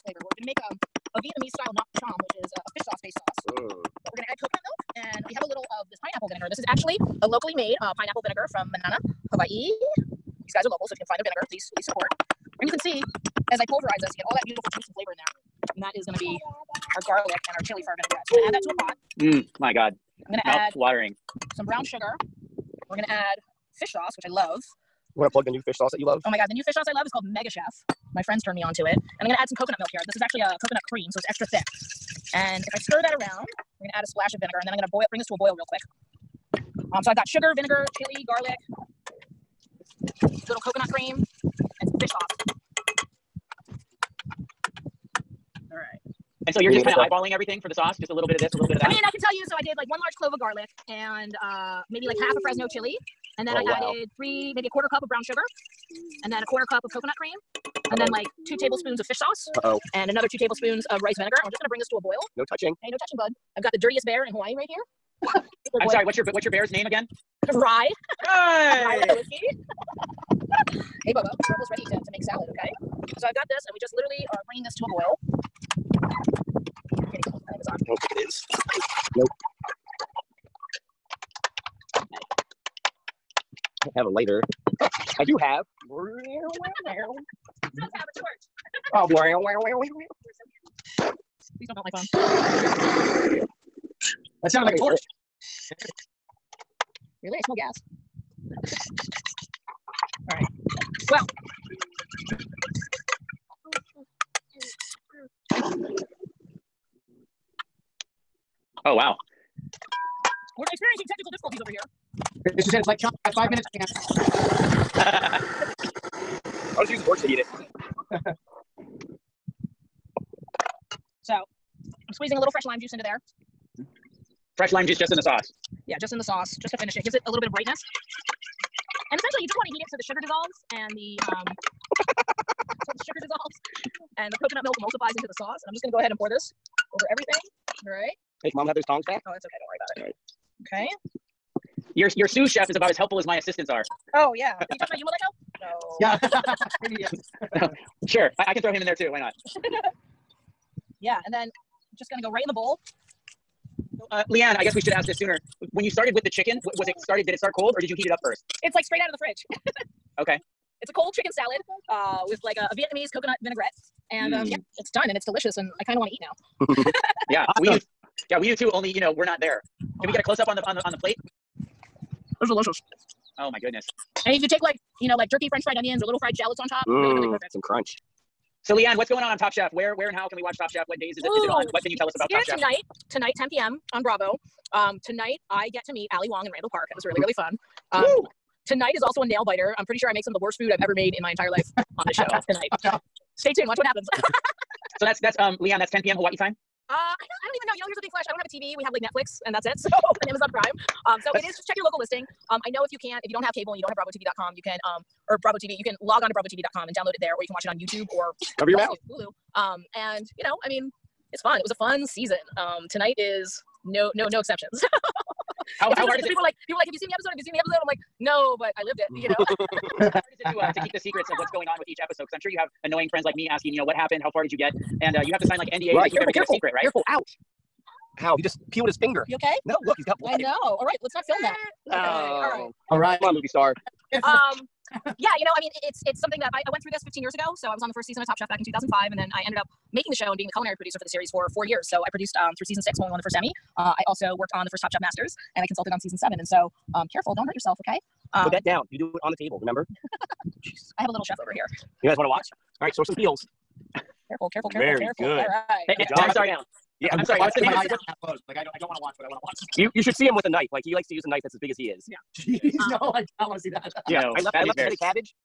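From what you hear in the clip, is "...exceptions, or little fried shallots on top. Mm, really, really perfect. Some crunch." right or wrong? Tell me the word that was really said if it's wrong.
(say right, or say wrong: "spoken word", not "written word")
wrong: "onions", not "exceptions".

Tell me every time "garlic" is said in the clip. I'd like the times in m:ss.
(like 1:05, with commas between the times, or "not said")
0:17, 0:38, 0:50.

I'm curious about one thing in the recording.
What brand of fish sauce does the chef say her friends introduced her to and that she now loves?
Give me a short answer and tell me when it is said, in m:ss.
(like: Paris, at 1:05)
Mega Chef, at 0:27.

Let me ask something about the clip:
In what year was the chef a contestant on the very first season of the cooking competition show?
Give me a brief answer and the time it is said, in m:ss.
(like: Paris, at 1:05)
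2005, at 3:58.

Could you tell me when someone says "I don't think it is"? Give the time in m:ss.
1:16.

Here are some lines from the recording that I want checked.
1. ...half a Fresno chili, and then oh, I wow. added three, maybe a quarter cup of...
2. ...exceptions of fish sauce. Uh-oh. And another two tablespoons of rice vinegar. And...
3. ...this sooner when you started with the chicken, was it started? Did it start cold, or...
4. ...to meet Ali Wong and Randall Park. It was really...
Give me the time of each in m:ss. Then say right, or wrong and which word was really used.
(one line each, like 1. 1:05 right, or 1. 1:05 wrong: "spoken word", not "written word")
1. 0:52 right
2. 0:58 wrong: "tablespoons", not "exceptions"
3. 2:35 right
4. 3:05 right.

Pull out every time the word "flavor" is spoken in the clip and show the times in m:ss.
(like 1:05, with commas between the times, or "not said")
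0:00, 0:14.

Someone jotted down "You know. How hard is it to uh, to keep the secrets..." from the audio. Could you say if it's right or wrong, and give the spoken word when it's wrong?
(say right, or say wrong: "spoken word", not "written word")
right.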